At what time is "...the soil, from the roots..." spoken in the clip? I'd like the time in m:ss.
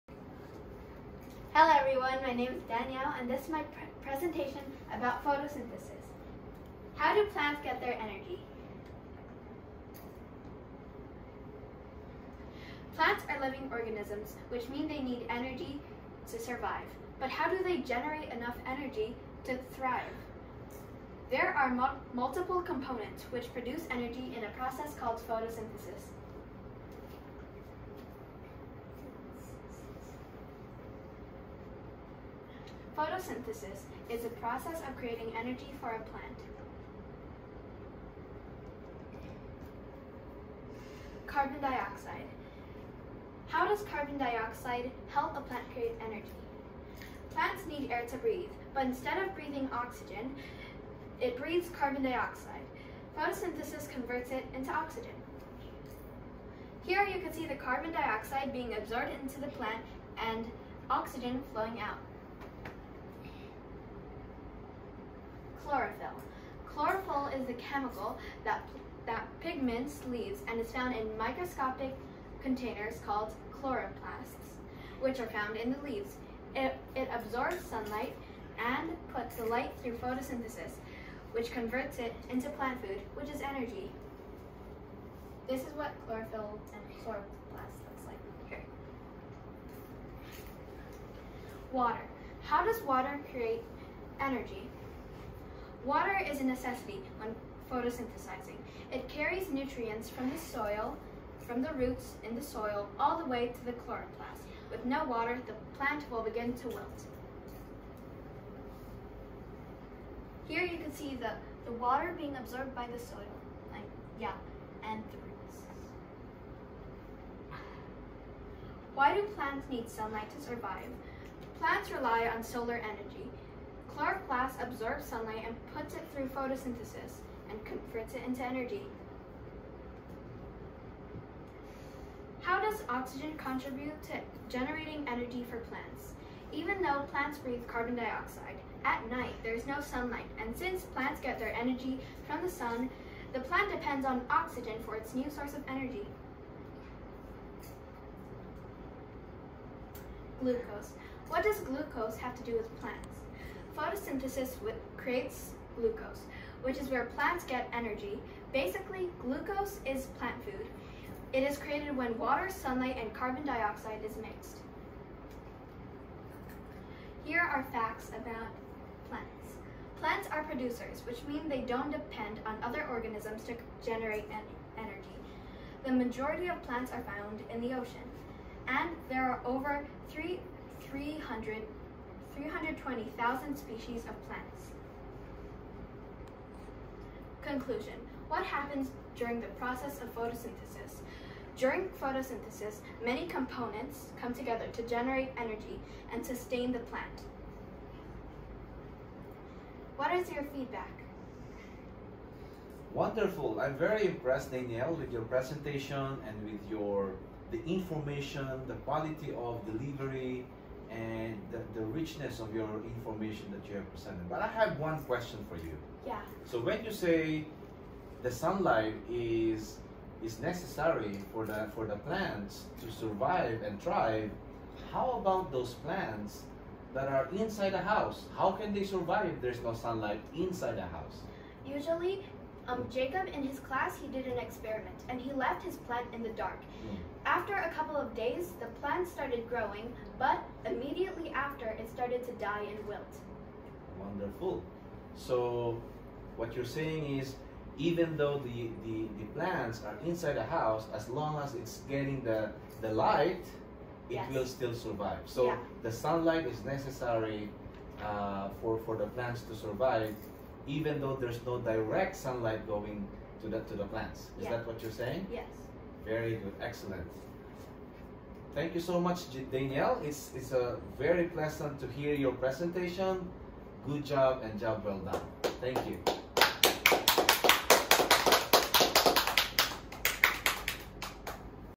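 1:40.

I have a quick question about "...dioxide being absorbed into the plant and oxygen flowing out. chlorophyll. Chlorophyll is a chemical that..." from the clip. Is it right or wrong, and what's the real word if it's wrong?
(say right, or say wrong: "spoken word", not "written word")
right.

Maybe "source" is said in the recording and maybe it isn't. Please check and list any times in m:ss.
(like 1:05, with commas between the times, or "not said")
2:25.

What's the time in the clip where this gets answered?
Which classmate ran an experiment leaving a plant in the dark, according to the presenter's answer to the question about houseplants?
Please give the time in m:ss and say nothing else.
3:52.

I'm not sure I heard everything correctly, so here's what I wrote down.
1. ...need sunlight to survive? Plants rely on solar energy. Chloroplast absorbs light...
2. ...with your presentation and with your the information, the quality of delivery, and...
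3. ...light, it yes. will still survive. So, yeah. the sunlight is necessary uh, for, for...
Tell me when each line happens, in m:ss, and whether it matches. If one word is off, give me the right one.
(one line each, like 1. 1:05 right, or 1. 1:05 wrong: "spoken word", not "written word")
1. 1:59 wrong: "sunlight", not "light"
2. 3:24 right
3. 4:12 right.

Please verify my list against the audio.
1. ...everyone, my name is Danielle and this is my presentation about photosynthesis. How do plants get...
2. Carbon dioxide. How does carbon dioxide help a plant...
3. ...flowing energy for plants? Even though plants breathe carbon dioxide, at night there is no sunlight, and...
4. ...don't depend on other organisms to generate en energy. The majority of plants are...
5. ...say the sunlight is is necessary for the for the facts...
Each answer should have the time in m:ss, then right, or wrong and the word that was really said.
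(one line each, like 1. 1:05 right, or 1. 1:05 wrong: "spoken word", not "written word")
1. 0:01 right
2. 0:41 right
3. 2:14 wrong: "generating", not "flowing"
4. 2:51 right
5. 3:36 wrong: "plants", not "facts".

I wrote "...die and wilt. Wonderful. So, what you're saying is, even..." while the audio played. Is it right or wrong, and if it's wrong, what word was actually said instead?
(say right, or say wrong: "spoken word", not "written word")
right.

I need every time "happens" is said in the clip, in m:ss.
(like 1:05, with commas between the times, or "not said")
3:08.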